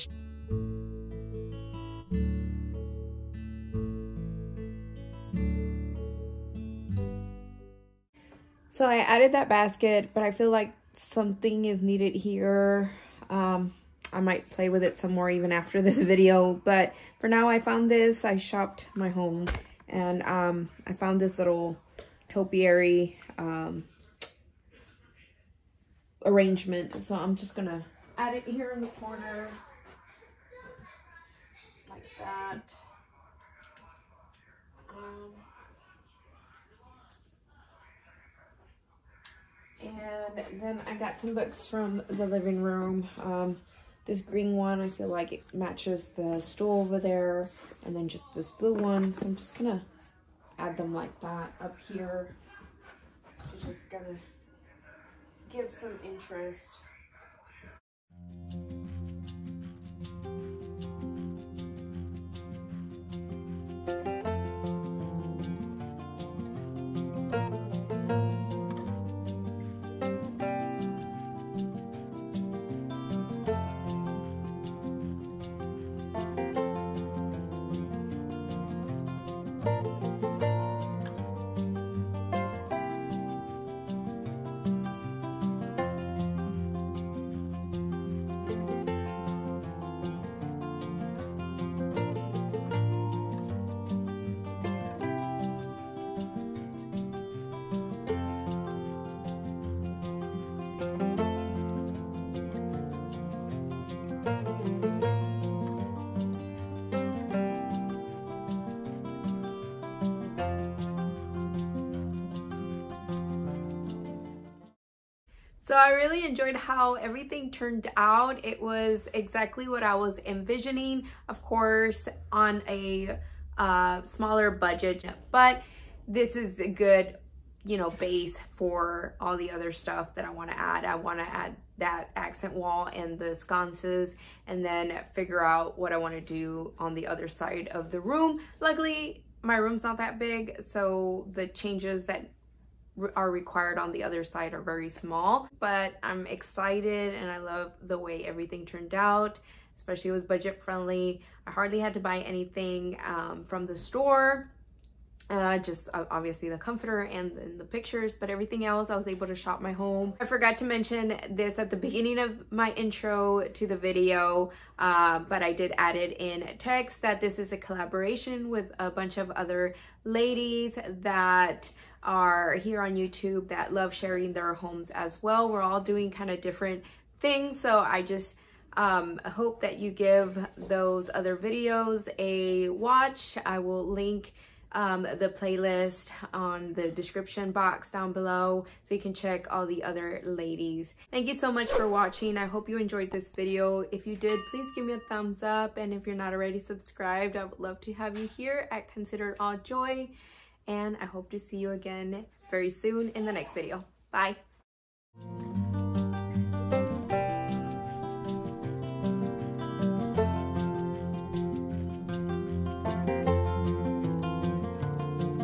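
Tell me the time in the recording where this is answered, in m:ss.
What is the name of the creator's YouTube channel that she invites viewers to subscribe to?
3:18.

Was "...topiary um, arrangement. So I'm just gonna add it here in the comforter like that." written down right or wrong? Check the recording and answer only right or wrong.
wrong.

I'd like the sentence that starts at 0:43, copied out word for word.
Um, this green one, I feel like it matches the stool over there.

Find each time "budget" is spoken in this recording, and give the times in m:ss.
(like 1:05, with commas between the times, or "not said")
2:04, 2:30.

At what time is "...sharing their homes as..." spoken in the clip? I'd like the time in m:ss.
2:53.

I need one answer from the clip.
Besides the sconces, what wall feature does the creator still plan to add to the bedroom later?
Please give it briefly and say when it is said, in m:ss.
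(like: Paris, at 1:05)
Accent wall, at 2:12.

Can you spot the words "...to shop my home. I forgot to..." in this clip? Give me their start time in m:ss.
2:39.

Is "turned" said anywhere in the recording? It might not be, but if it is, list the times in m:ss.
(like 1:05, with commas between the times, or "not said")
1:57, 2:28.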